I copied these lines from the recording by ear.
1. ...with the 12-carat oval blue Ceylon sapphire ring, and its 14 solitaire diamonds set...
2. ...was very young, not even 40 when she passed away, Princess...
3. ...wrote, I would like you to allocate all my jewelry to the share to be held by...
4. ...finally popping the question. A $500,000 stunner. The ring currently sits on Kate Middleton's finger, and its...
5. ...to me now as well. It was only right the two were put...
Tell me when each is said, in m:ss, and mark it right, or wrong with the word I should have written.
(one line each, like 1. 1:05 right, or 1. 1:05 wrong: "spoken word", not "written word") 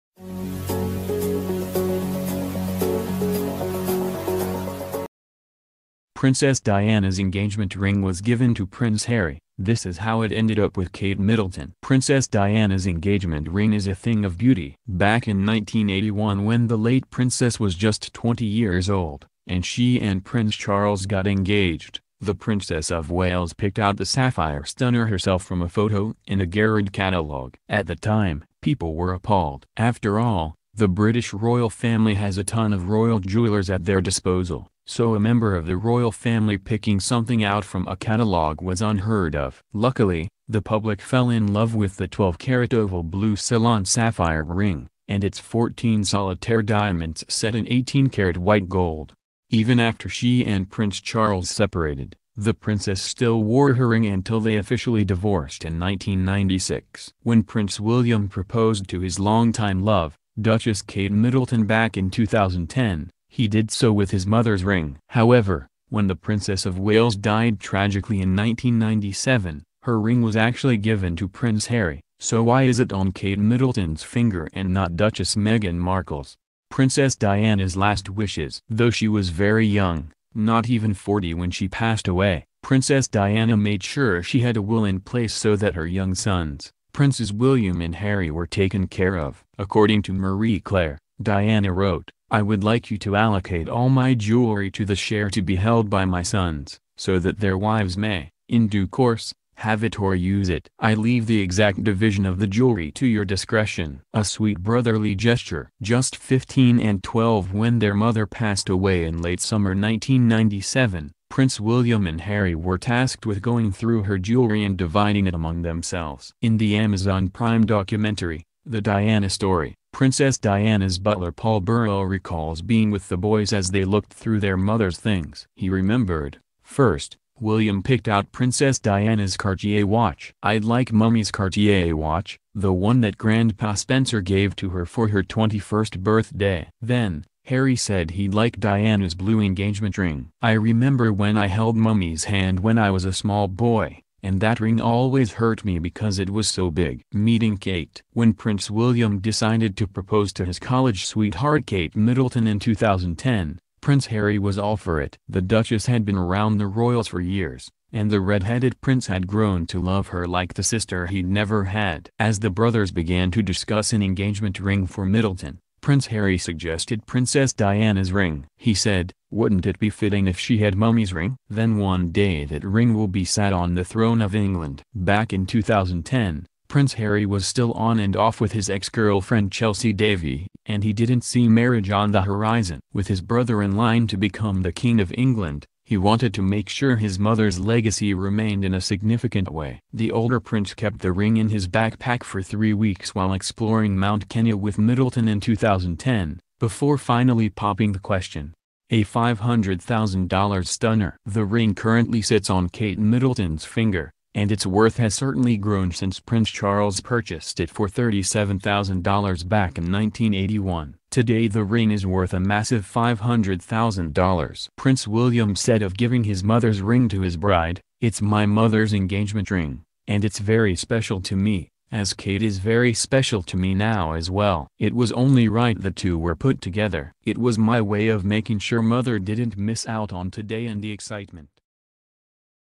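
1. 0:41 right
2. 1:19 right
3. 1:31 right
4. 3:16 right
5. 3:43 right.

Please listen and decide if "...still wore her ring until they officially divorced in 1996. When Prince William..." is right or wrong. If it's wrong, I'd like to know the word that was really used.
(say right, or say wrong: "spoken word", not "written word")
right.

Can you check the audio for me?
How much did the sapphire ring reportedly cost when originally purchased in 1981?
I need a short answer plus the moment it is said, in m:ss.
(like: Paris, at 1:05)
$37,000, at 3:27.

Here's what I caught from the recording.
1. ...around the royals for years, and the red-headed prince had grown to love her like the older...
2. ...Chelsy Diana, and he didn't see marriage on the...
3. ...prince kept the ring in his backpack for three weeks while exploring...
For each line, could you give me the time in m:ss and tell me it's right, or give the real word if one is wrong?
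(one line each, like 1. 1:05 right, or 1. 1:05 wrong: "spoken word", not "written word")
1. 2:36 wrong: "sister", not "older"
2. 2:59 wrong: "Davy", not "Diana"
3. 3:10 right.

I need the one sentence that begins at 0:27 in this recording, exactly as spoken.
At the time, people were appalled.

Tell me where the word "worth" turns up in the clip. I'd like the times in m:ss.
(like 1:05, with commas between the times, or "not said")
3:24, 3:32.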